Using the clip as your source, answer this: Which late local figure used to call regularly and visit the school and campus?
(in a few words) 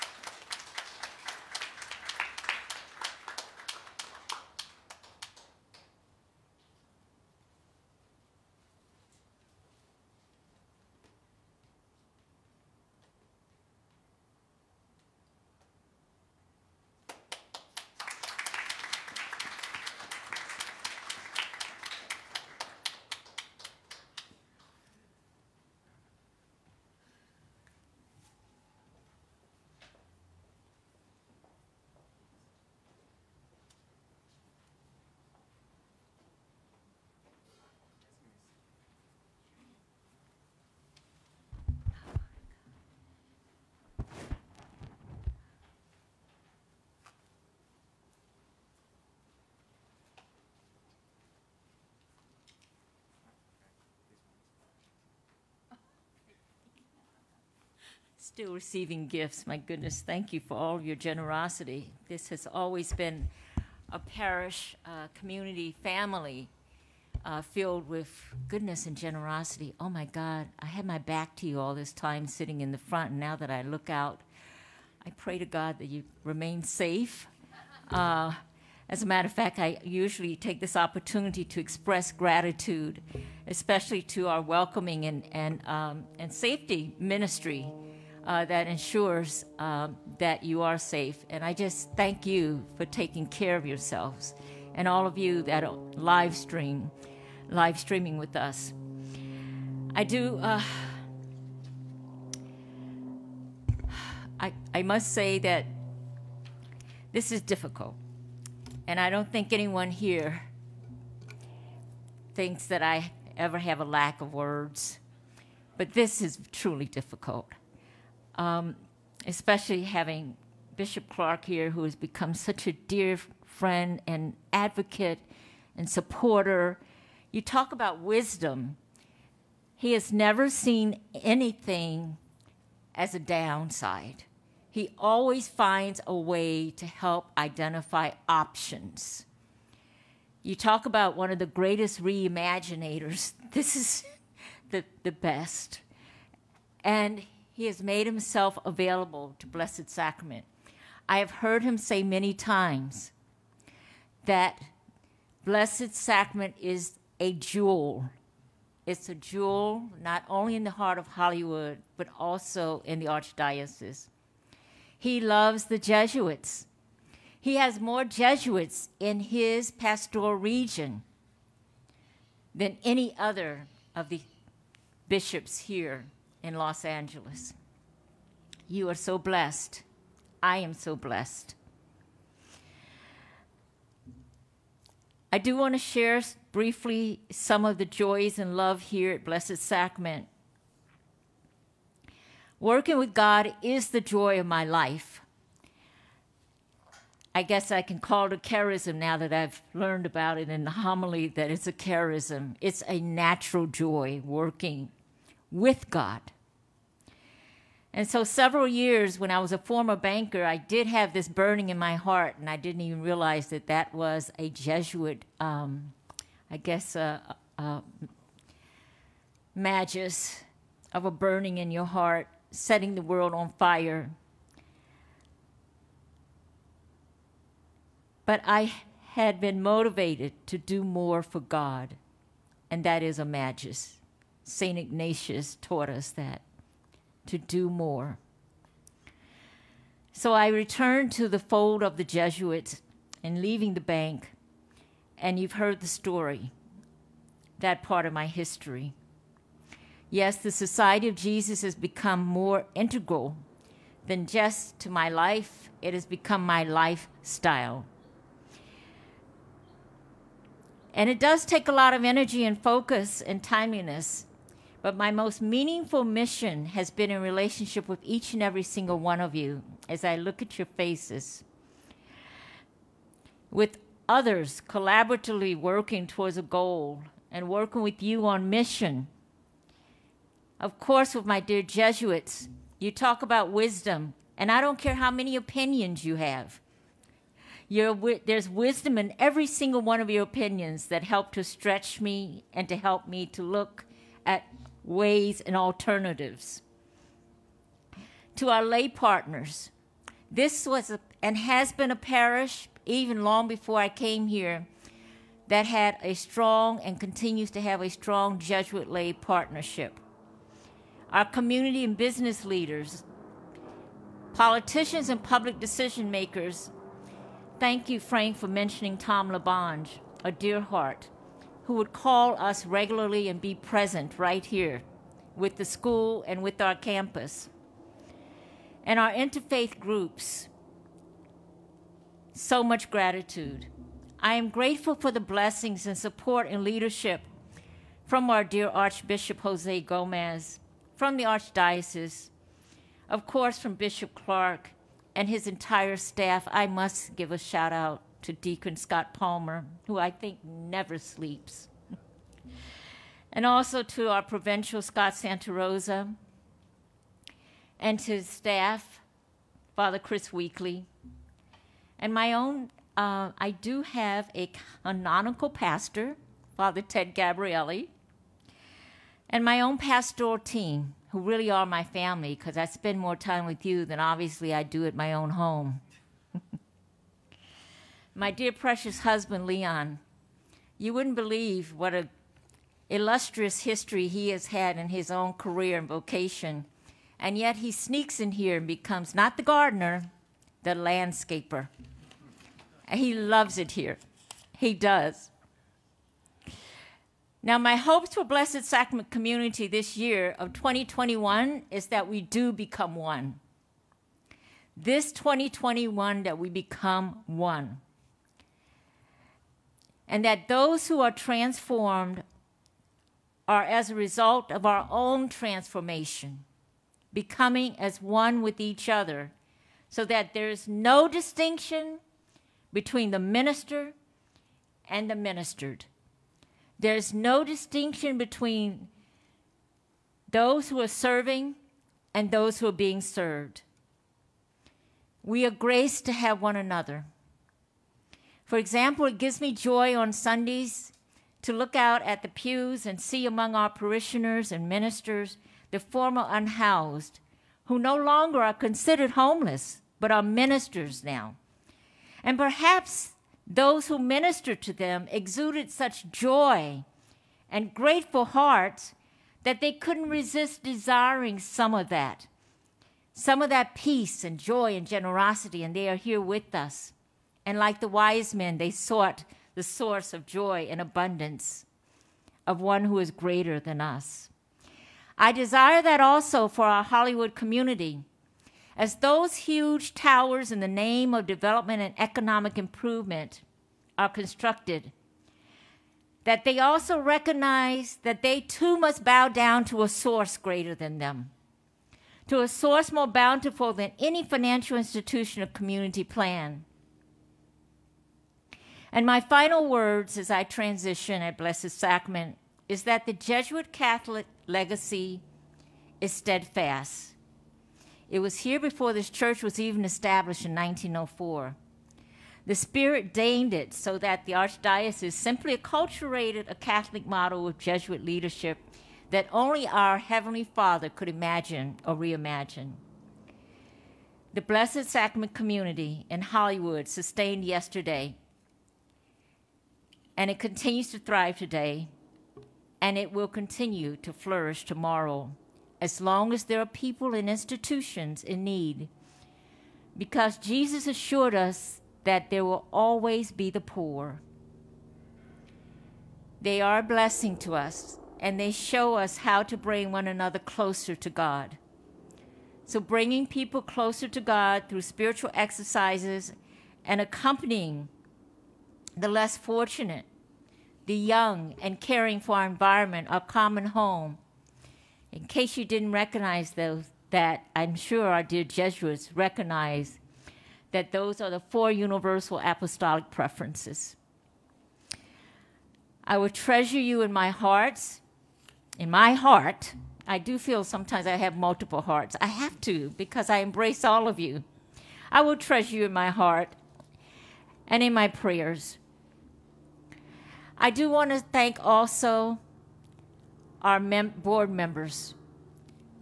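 Tom LaBonge.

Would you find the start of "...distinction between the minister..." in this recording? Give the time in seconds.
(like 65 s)
421 s.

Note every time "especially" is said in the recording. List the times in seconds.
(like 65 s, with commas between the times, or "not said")
83 s, 119 s.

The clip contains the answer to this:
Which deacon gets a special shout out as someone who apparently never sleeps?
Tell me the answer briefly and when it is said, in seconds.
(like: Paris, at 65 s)
Deacon Scott Palmer, at 348 s.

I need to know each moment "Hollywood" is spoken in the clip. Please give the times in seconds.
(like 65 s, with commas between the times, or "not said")
161 s, 476 s, 526 s.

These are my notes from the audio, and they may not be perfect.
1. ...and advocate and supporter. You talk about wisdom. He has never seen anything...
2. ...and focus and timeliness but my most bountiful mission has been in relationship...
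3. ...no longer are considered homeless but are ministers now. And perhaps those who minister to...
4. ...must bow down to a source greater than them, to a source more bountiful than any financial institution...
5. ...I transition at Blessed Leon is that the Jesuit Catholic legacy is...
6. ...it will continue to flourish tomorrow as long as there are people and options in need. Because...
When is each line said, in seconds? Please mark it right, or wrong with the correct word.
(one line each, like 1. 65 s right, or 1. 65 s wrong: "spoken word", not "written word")
1. 124 s right
2. 262 s wrong: "meaningful", not "bountiful"
3. 447 s right
4. 488 s right
5. 500 s wrong: "Sacrament", not "Leon"
6. 532 s wrong: "institutions", not "options".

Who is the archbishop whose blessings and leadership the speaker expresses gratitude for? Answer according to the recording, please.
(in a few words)
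Jose Gomez.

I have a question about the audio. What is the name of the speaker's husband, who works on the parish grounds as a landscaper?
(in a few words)
Leon.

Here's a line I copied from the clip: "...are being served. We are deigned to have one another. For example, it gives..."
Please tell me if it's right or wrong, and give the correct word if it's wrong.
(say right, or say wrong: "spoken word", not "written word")
wrong: "graced", not "deigned".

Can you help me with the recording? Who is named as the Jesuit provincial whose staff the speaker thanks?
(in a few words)
Scott Santarosa.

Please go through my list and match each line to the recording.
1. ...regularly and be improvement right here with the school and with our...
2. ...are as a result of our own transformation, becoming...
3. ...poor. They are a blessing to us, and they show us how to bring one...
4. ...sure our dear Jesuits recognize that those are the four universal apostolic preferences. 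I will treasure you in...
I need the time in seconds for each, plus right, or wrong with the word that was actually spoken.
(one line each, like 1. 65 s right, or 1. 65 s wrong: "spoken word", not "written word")
1. 322 s wrong: "present", not "improvement"
2. 413 s right
3. 543 s right
4. 567 s right.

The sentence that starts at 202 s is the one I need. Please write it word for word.
It's a natural joy working with God.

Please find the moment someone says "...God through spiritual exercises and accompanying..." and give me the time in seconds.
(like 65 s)
554 s.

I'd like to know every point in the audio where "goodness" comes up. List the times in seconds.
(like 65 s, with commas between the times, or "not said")
59 s, 68 s.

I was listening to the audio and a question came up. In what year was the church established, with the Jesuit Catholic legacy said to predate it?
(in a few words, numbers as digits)
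1904.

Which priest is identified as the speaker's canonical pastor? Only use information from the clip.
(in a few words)
Father Ted Gabrielli.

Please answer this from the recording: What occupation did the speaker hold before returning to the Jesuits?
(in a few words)
Banker.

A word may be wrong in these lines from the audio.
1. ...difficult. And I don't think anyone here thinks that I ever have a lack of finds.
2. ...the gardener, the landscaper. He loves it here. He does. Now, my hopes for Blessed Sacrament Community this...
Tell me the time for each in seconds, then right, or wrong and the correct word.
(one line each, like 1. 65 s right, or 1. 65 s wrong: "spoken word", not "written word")
1. 107 s wrong: "words", not "finds"
2. 389 s right.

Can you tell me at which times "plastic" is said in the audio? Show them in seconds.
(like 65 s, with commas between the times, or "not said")
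not said.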